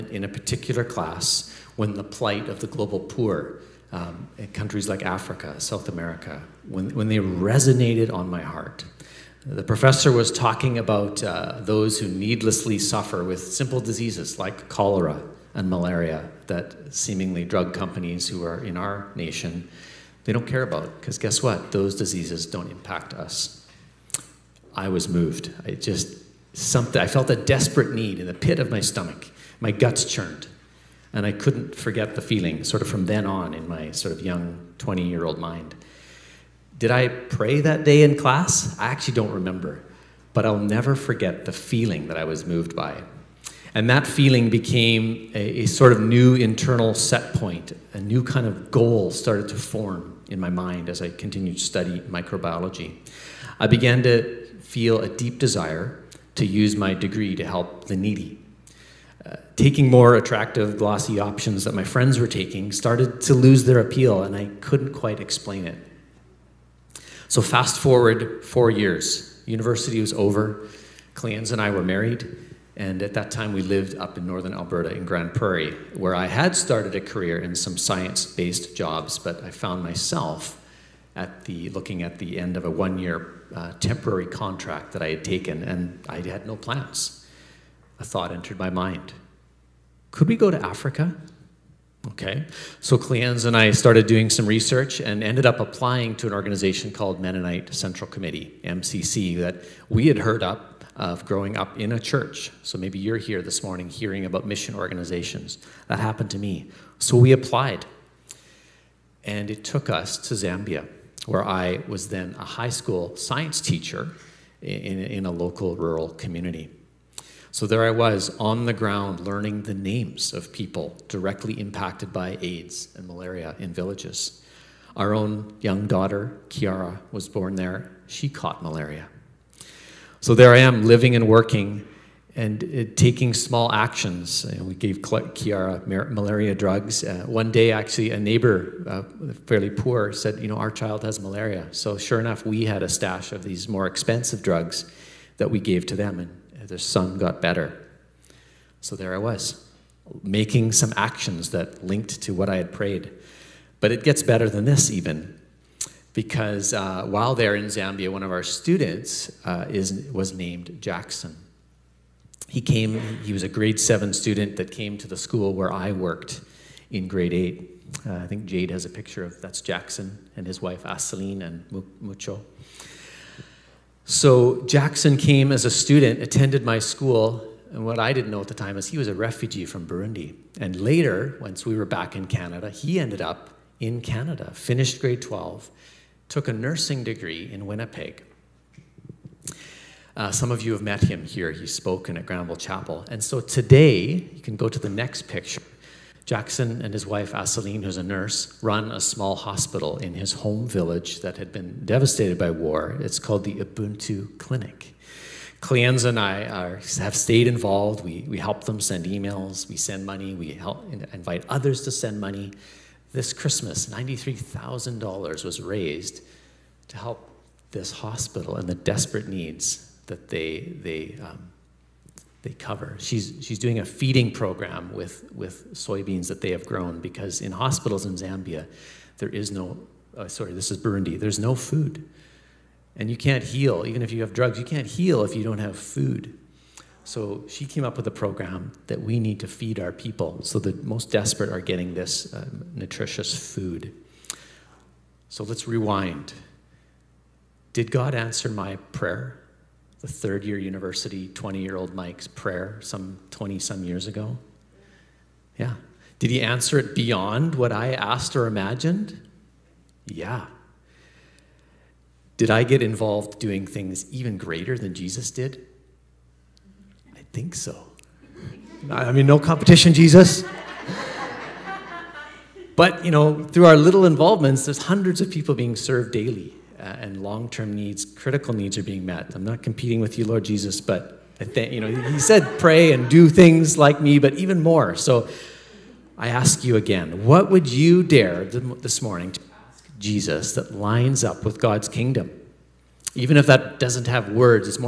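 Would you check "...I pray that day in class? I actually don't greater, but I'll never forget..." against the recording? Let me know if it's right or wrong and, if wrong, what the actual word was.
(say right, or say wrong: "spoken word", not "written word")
wrong: "remember", not "greater".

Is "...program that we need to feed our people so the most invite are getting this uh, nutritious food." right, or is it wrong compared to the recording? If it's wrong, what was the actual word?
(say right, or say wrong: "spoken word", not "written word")
wrong: "desperate", not "invite".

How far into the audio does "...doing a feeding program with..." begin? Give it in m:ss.
3:43.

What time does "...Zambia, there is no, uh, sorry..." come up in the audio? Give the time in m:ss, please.
3:48.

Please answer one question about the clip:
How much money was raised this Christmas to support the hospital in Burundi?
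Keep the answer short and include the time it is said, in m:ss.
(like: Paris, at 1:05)
$93,000, at 3:33.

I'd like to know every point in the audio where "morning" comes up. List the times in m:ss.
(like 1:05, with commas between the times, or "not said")
1:43, 4:49.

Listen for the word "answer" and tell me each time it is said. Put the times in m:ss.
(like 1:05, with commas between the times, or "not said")
4:08, 4:16.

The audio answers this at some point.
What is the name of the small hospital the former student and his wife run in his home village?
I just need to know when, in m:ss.
3:23.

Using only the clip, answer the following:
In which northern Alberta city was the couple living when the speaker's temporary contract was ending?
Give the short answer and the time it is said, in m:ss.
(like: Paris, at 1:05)
Grande Prairie, at 1:15.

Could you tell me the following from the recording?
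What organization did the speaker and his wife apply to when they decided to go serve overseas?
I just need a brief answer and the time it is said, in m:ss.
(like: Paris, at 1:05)
Mennonite Central Committee, at 1:37.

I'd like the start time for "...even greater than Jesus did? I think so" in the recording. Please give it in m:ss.
4:24.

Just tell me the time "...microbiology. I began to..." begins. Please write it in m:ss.
0:52.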